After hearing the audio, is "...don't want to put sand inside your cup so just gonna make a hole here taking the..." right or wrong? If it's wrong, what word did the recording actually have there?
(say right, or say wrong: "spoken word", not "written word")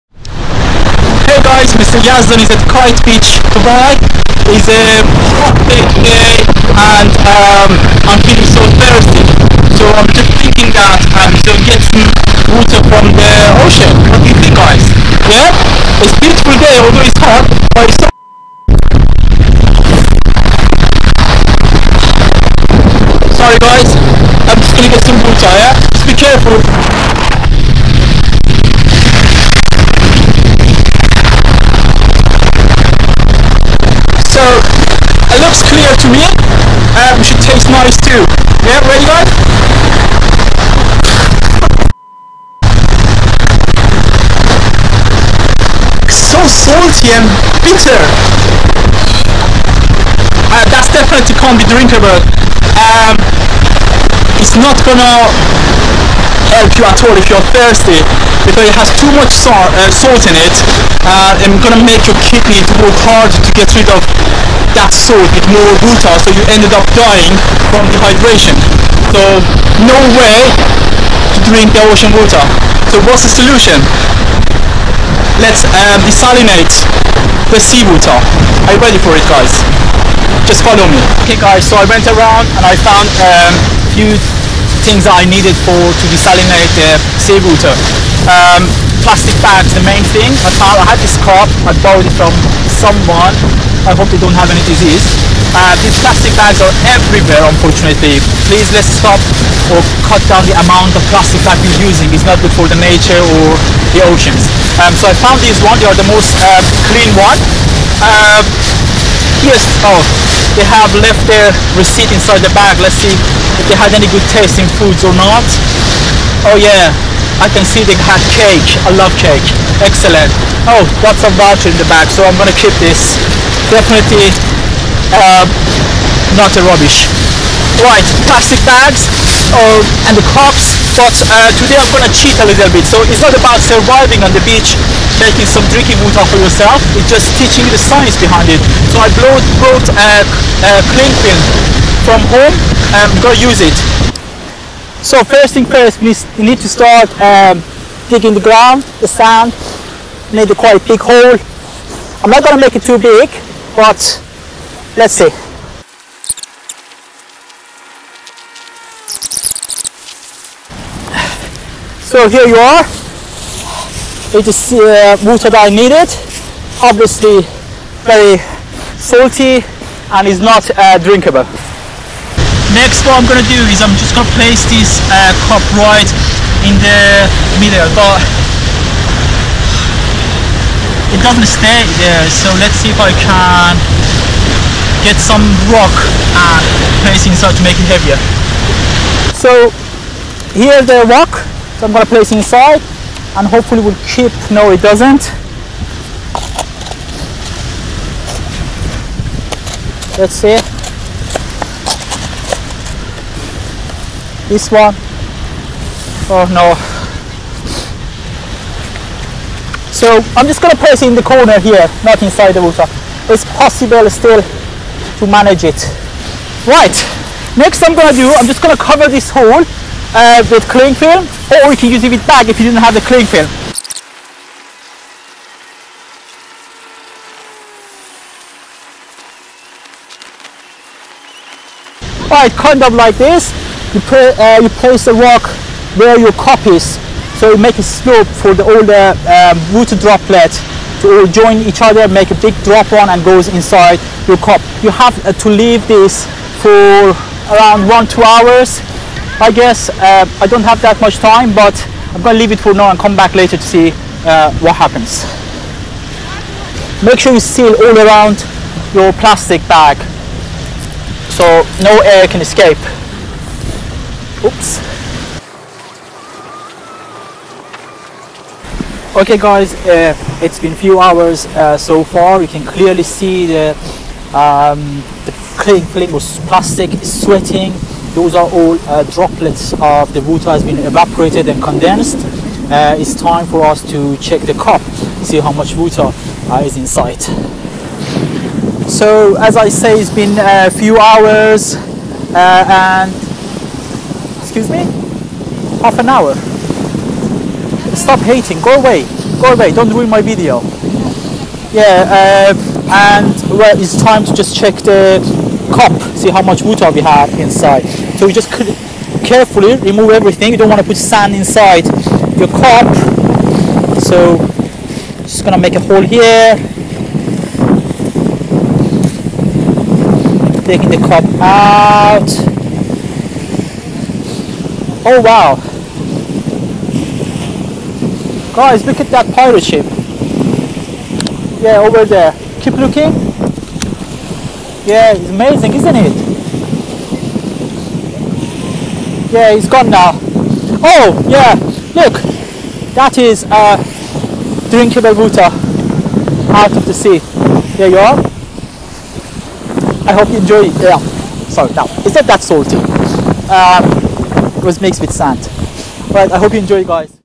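right.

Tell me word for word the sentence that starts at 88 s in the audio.
Um, plastic bags, the main thing.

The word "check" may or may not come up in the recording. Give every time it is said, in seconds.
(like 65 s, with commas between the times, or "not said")
284 s, 304 s.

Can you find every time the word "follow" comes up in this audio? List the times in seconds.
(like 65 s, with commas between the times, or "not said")
80 s.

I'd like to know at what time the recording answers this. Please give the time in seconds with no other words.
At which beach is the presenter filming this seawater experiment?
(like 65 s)
2 s.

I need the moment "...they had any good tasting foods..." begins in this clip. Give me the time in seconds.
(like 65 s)
113 s.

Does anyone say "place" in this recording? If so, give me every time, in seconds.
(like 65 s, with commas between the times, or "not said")
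174 s, 187 s, 192 s, 210 s, 234 s.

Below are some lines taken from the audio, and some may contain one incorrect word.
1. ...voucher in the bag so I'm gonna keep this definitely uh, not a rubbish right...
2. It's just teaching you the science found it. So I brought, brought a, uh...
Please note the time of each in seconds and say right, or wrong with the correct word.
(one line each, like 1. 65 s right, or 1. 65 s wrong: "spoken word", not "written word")
1. 121 s right
2. 136 s wrong: "behind", not "found".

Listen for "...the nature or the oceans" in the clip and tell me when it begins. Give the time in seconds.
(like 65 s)
102 s.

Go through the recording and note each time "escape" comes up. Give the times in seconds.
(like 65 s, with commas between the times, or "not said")
262 s.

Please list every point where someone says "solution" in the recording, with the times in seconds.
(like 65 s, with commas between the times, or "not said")
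73 s.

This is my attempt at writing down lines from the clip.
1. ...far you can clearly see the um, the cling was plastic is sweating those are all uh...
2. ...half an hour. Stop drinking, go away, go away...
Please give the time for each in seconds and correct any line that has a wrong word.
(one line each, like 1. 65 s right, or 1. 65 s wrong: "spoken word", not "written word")
1. 272 s right
2. 295 s wrong: "hating", not "drinking".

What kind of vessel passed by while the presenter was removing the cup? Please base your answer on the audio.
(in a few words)
pirate ship.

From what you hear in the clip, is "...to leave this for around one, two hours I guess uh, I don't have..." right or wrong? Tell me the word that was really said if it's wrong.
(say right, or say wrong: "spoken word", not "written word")
right.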